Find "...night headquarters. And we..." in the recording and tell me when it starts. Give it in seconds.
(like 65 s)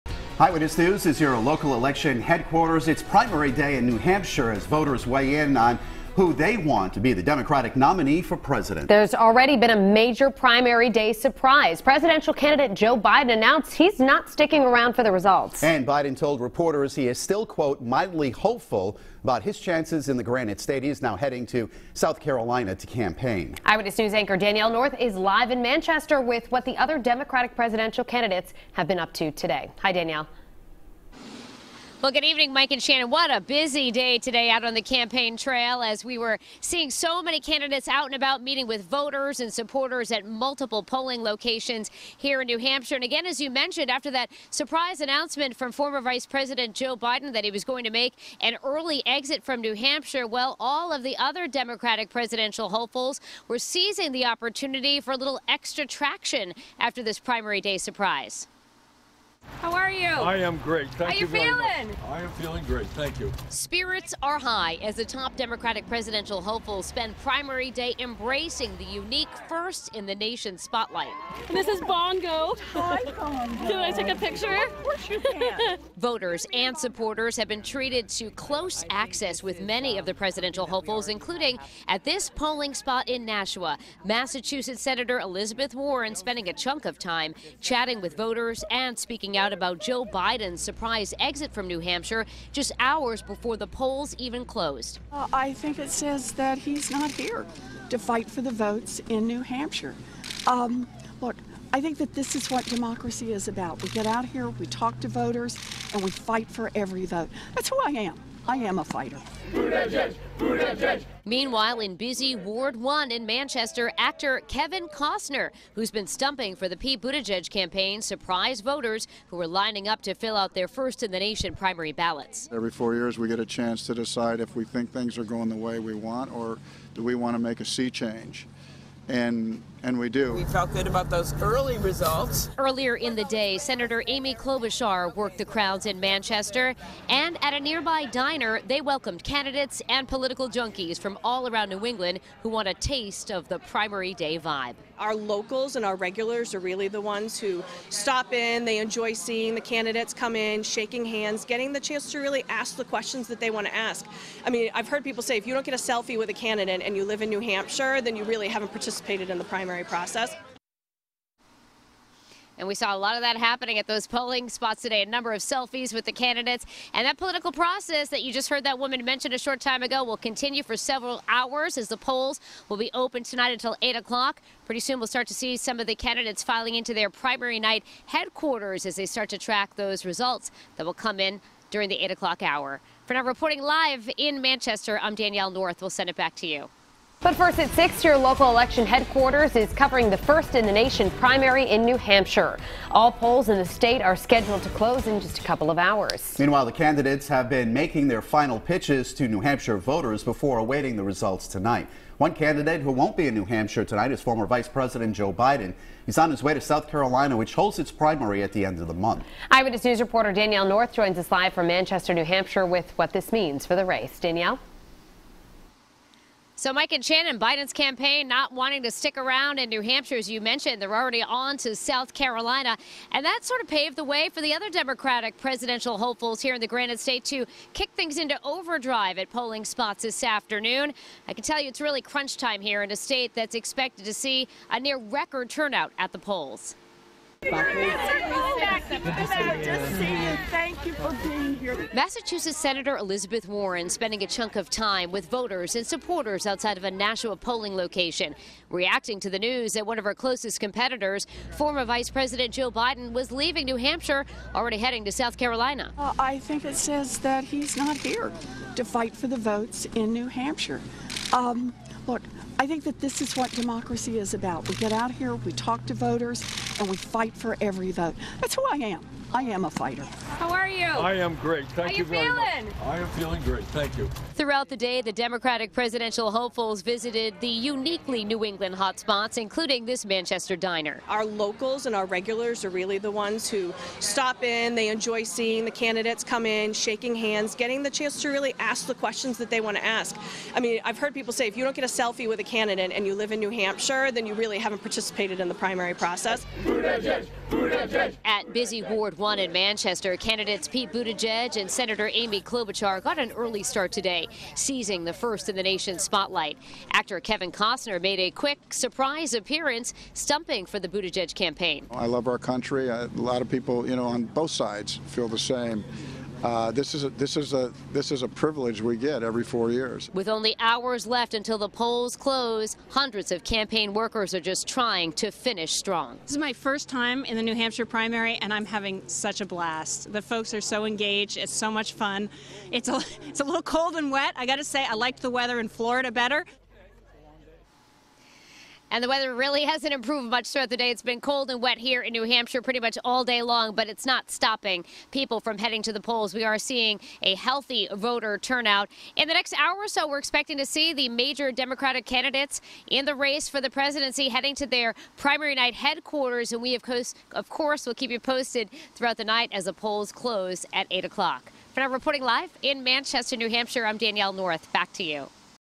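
355 s.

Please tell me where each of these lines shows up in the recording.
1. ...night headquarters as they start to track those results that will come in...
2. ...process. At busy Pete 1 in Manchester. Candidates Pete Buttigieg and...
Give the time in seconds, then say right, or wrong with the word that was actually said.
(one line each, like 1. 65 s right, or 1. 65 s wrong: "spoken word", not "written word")
1. 177 s right
2. 295 s wrong: "Ward", not "Pete".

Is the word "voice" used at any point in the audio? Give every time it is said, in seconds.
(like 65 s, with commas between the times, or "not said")
not said.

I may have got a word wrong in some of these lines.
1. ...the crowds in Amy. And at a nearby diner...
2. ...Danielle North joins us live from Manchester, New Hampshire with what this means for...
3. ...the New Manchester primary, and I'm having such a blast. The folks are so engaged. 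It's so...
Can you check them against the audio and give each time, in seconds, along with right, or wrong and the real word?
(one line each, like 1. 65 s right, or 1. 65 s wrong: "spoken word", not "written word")
1. 135 s wrong: "Manchester", not "Amy"
2. 210 s right
3. 327 s wrong: "Hampshire", not "Manchester".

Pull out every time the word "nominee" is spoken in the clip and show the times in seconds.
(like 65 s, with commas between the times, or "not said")
7 s.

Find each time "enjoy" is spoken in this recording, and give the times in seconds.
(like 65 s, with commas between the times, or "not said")
148 s, 284 s.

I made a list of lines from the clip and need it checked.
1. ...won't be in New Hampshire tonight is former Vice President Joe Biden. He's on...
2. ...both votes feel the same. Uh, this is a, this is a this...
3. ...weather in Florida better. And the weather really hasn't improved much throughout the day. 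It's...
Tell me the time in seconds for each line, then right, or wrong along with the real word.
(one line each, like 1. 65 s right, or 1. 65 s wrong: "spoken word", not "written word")
1. 202 s right
2. 314 s wrong: "sides", not "votes"
3. 335 s right.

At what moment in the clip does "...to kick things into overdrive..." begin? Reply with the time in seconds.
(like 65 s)
227 s.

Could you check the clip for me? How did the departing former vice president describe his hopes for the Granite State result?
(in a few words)
mildly hopeful.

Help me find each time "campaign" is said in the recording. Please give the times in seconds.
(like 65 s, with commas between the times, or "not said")
22 s, 34 s, 117 s, 217 s, 311 s, 323 s.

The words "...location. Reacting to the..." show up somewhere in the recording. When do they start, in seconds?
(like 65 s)
247 s.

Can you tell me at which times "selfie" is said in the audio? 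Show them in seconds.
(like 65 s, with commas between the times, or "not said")
155 s, 165 s, 291 s.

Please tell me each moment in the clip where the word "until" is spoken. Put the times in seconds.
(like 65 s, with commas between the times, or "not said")
173 s, 321 s.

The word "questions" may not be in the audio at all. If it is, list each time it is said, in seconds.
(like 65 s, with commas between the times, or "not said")
152 s, 288 s.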